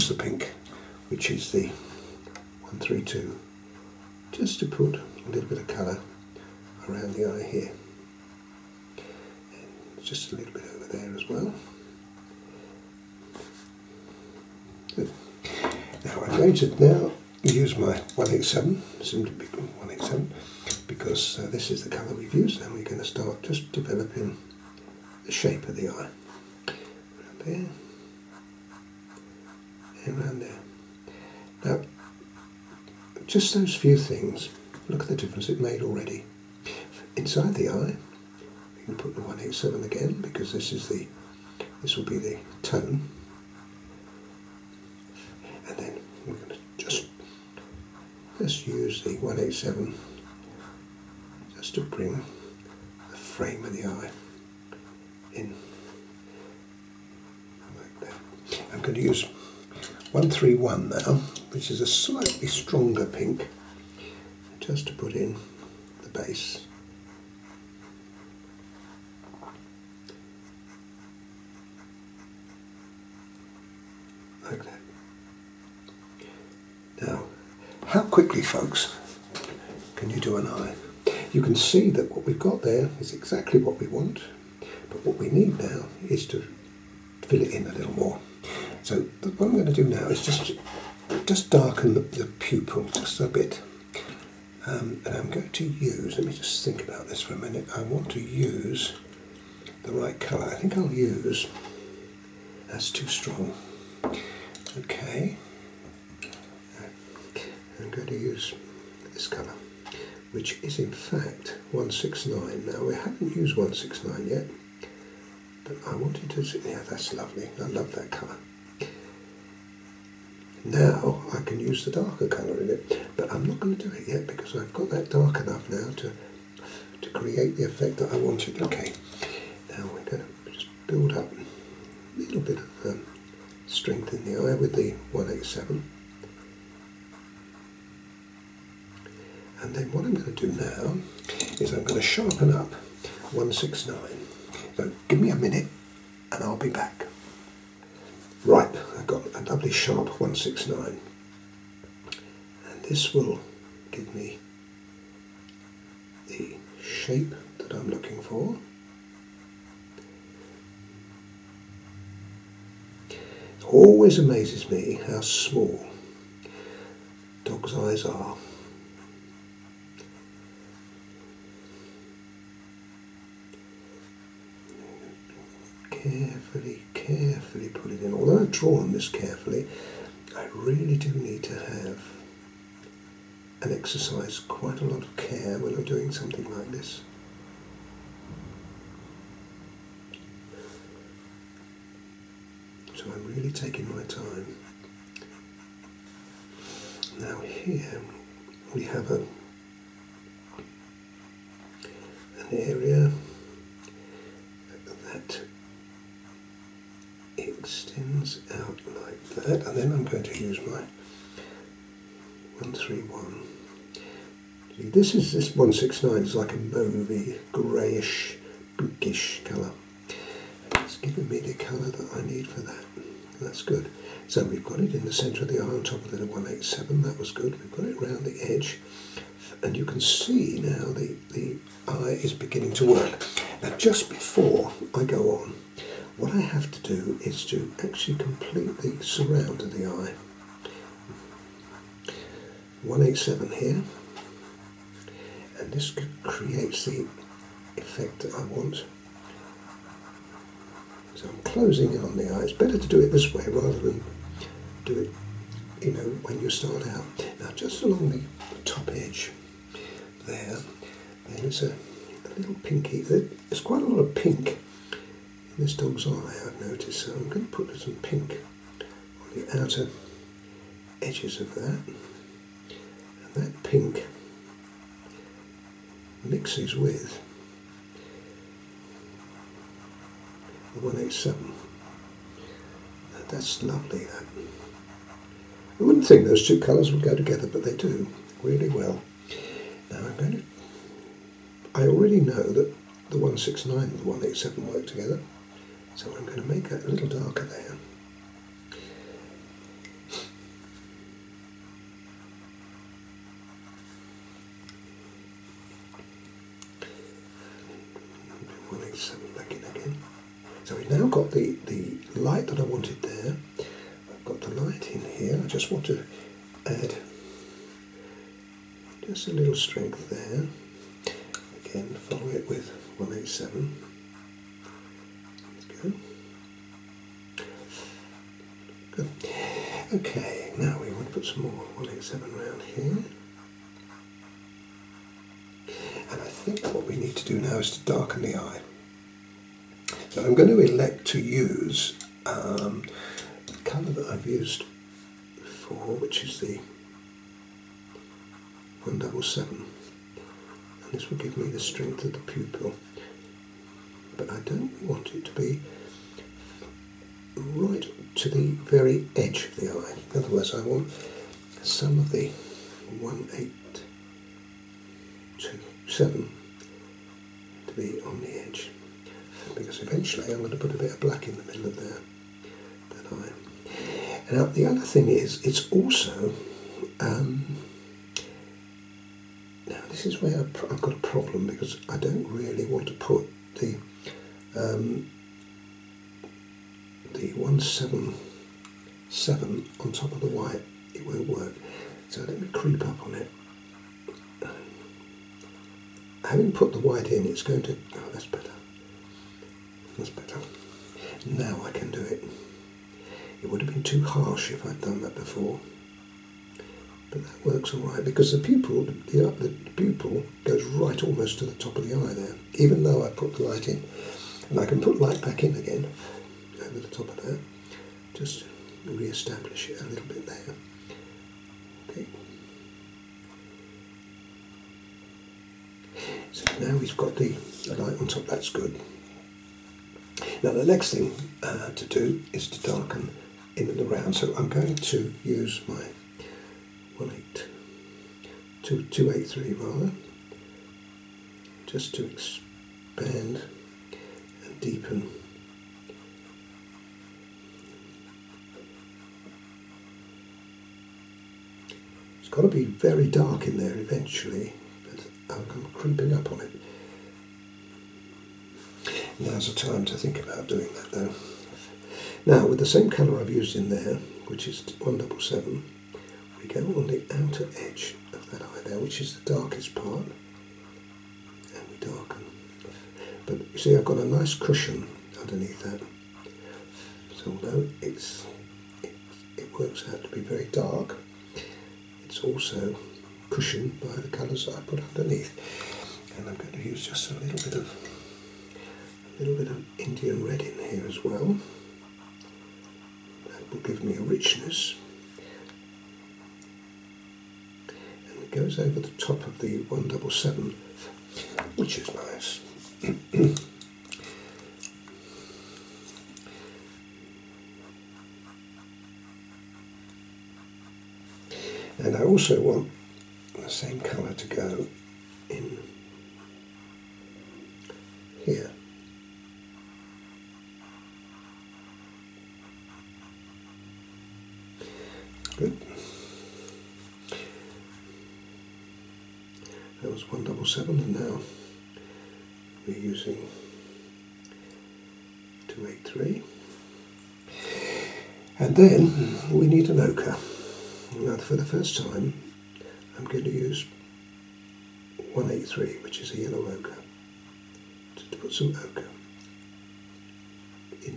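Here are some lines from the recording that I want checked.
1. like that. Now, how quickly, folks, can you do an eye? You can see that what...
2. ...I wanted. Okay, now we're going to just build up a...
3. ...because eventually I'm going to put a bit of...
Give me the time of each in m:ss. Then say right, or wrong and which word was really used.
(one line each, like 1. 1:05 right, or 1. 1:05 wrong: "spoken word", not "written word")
1. 1:14 right
2. 2:08 right
3. 6:09 right.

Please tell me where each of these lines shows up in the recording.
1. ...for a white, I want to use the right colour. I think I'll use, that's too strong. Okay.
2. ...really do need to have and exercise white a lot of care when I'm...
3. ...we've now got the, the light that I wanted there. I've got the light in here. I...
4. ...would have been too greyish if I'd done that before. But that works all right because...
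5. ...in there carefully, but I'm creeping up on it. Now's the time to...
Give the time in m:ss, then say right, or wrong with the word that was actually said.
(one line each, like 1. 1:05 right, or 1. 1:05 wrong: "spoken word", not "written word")
1. 1:37 wrong: "minute", not "white"
2. 3:00 wrong: "quite", not "white"
3. 5:10 right
4. 6:43 wrong: "harsh", not "greyish"
5. 7:33 wrong: "eventually", not "carefully".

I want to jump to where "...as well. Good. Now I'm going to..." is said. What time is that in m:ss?
0:11.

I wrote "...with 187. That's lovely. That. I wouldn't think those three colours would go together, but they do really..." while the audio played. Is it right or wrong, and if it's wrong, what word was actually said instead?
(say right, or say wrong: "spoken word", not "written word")
wrong: "two", not "three".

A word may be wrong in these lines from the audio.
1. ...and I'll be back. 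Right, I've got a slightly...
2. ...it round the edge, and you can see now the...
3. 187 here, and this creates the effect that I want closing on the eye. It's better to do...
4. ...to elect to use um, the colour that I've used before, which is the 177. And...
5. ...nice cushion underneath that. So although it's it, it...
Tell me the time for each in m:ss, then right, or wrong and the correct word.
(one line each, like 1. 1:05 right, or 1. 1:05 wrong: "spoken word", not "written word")
1. 2:26 wrong: "lovely", not "slightly"
2. 3:47 right
3. 4:02 right
4. 5:40 right
5. 7:54 right.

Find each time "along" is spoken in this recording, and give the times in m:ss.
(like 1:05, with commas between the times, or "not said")
4:17.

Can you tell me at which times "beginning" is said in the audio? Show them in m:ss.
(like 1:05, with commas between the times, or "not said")
3:52.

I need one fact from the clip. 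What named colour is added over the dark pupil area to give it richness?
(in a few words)
Indian red.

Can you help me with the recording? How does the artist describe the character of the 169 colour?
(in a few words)
mauvey, greyish.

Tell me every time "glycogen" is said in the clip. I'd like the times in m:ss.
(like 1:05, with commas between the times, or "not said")
not said.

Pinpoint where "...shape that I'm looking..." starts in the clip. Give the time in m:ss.
2:36.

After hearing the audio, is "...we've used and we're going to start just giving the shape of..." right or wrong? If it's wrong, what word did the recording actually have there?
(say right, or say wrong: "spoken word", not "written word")
wrong: "developing", not "giving".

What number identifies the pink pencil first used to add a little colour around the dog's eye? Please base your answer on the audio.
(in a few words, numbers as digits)
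132.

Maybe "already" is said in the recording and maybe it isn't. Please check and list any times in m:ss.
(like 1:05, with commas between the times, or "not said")
0:35, 4:51.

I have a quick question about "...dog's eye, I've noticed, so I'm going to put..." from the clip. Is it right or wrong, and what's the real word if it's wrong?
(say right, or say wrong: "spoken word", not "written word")
right.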